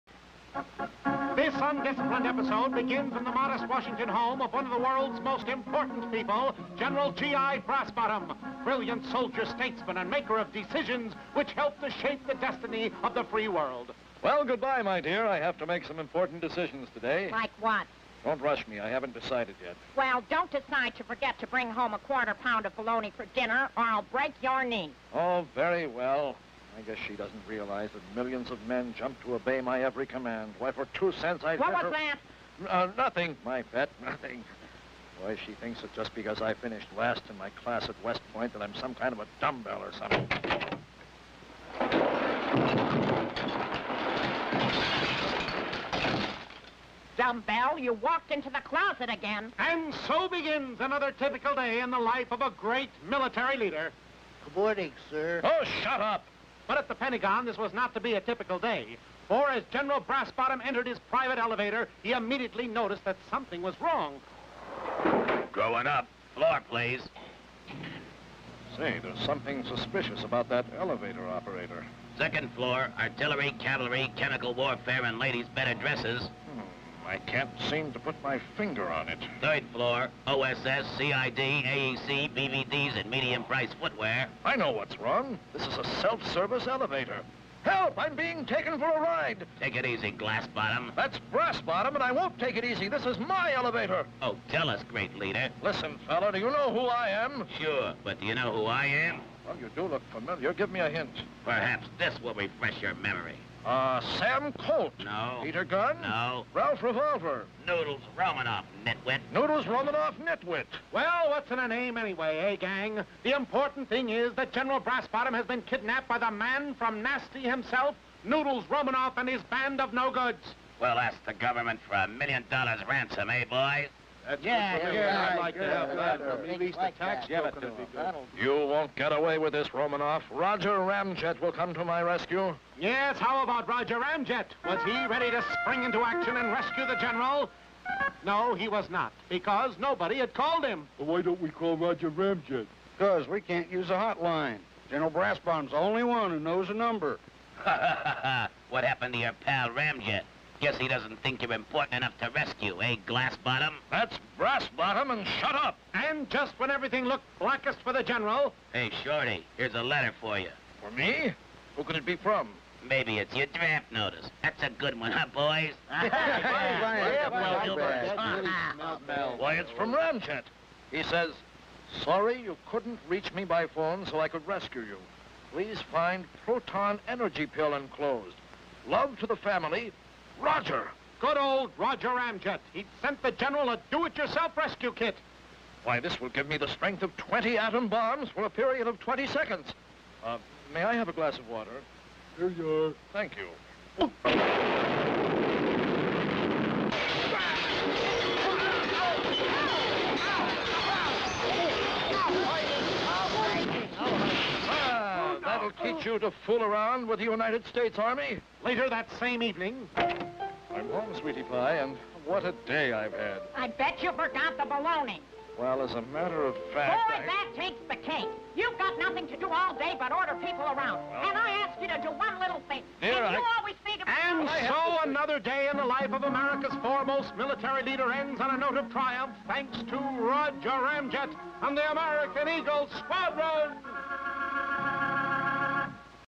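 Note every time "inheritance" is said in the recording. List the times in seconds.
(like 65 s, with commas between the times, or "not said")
not said.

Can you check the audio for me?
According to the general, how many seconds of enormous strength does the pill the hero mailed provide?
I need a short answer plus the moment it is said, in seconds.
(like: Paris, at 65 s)
20 seconds, at 188 s.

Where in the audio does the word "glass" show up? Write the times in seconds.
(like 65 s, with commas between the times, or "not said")
90 s, 153 s, 191 s.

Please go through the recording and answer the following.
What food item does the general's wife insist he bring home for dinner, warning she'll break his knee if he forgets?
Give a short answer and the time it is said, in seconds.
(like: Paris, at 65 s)
bologna, at 22 s.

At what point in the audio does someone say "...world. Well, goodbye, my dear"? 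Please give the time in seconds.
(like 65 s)
13 s.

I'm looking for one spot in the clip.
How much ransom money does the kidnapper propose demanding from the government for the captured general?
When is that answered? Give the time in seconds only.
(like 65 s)
122 s.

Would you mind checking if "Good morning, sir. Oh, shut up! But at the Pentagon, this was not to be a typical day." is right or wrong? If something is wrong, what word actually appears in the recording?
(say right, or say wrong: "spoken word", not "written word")
right.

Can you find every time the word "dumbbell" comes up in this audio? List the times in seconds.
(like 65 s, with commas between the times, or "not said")
39 s, 47 s.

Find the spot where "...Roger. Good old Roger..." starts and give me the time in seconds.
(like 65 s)
180 s.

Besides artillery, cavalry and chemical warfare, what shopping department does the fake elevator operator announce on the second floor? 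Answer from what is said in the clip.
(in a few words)
ladies' better dresses.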